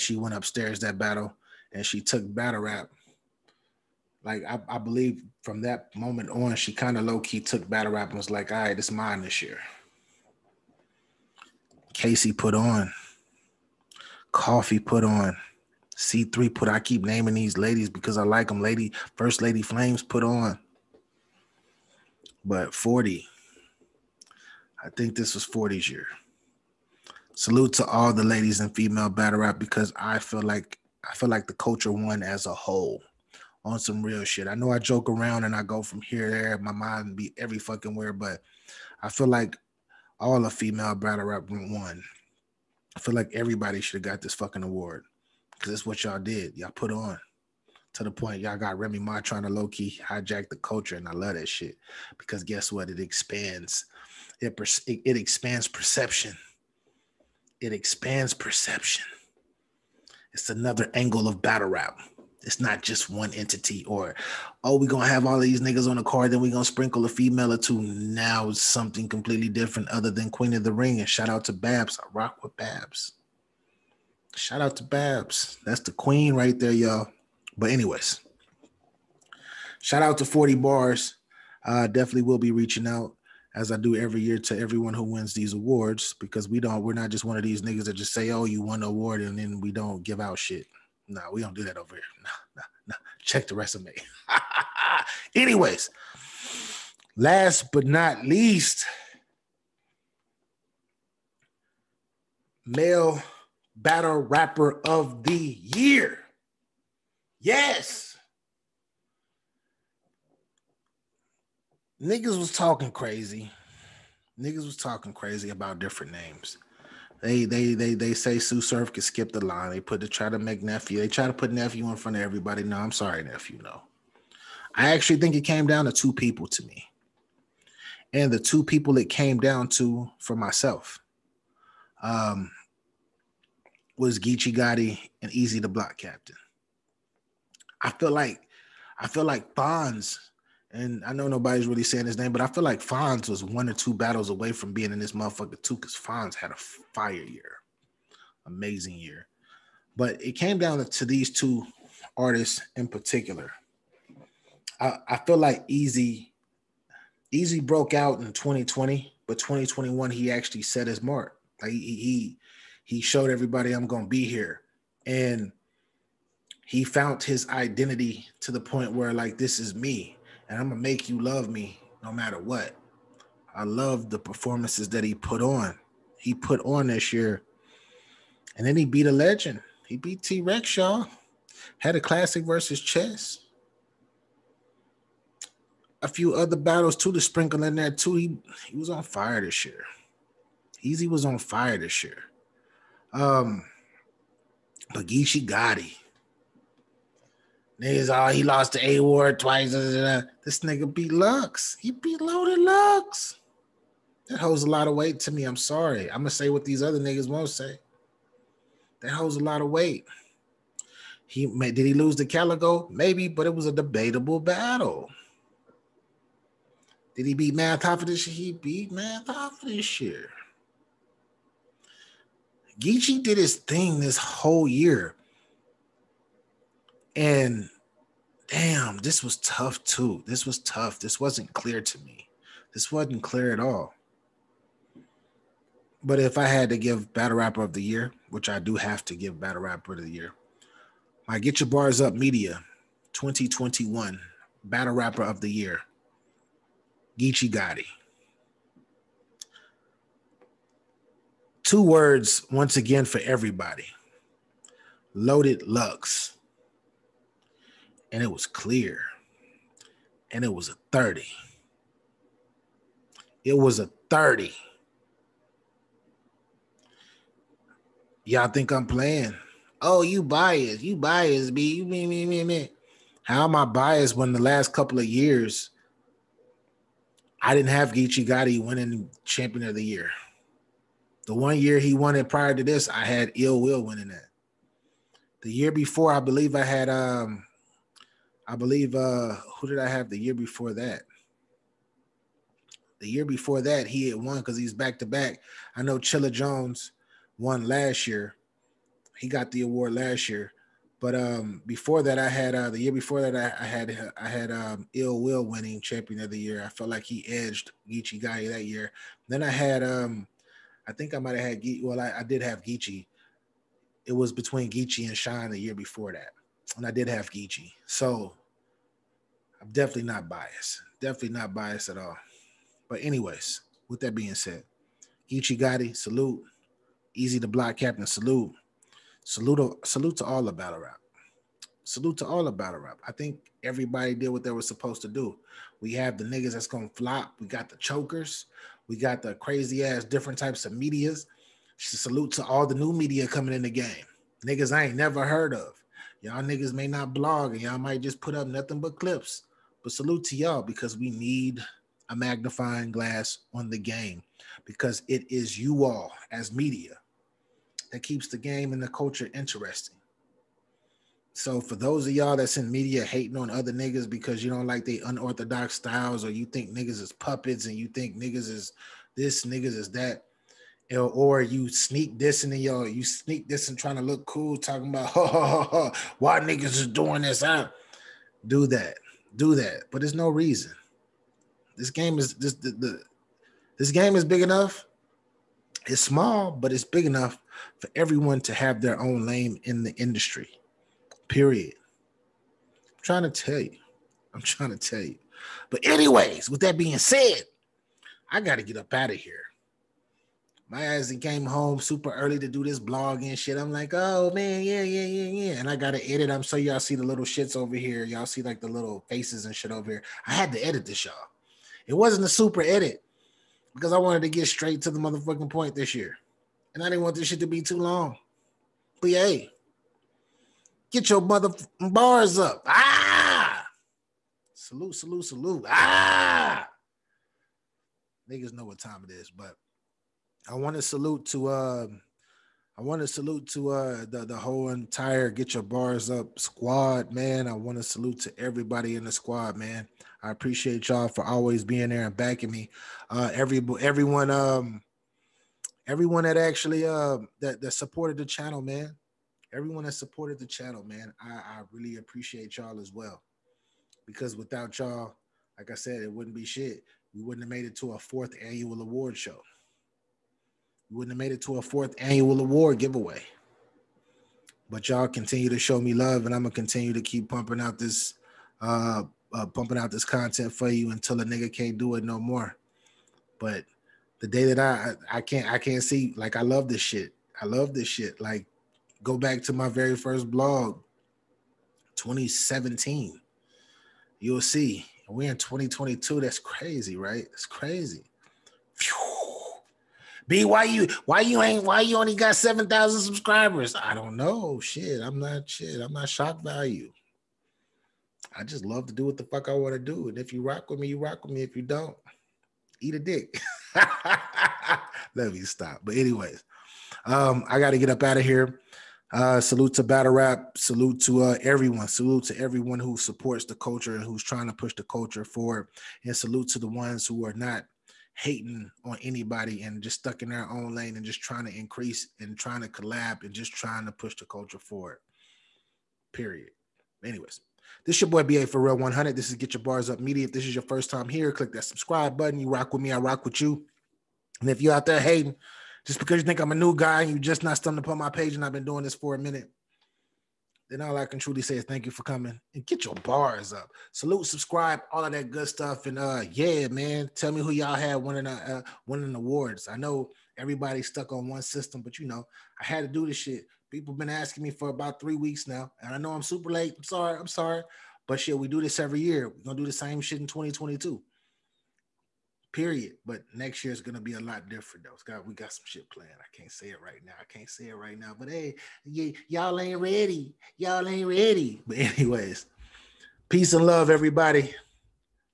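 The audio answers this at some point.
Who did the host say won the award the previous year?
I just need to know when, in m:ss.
4:55.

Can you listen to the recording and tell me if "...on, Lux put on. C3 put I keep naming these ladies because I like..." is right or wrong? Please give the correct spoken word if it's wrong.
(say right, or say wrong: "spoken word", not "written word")
wrong: "Coffee", not "Lux".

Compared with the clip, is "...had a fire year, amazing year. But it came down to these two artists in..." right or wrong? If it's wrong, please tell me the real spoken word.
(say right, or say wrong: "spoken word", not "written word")
right.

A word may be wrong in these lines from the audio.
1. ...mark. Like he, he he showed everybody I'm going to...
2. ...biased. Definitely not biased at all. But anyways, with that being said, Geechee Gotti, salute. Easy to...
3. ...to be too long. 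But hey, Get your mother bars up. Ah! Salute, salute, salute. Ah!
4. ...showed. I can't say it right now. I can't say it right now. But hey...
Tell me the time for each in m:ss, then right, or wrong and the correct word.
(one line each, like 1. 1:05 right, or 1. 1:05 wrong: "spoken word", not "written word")
1. 2:41 right
2. 5:20 right
3. 6:57 right
4. 9:25 wrong: "planned", not "showed".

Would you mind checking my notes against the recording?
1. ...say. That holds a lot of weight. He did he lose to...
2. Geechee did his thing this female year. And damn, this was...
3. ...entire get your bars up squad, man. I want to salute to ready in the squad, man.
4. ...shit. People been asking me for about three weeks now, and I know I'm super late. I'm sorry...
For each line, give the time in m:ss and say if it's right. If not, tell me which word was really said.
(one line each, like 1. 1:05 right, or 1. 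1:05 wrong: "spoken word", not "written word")
1. 3:27 right
2. 3:42 wrong: "whole", not "female"
3. 7:14 wrong: "everybody", not "ready"
4. 9:13 right.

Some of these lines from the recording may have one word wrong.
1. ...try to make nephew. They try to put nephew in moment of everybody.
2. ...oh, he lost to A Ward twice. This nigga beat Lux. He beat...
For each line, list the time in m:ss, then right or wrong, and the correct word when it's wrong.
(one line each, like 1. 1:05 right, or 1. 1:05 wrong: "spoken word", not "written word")
1. 2:00 wrong: "front", not "moment"
2. 3:18 right.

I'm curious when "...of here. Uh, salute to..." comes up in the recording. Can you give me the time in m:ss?
8:28.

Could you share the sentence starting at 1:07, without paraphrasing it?
Now it's something completely different other than Queen of the Ring.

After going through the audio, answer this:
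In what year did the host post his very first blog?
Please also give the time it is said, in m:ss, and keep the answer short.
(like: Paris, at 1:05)
2017, at 8:01.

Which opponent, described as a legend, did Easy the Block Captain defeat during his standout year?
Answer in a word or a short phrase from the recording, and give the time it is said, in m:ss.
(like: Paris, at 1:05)
T Rex, at 3:00.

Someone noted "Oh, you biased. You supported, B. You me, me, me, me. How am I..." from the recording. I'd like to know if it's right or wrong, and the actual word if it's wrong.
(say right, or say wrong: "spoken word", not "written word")
wrong: "biased", not "supported".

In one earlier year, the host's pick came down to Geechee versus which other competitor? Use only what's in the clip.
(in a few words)
Shine.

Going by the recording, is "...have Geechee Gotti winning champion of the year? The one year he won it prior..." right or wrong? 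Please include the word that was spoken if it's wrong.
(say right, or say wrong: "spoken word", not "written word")
right.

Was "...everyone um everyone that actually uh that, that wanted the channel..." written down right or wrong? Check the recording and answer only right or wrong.
wrong.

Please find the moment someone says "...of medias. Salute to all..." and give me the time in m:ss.
5:40.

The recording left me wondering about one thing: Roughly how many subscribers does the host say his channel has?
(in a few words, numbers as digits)
7,000.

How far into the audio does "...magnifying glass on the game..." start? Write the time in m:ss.
5:52.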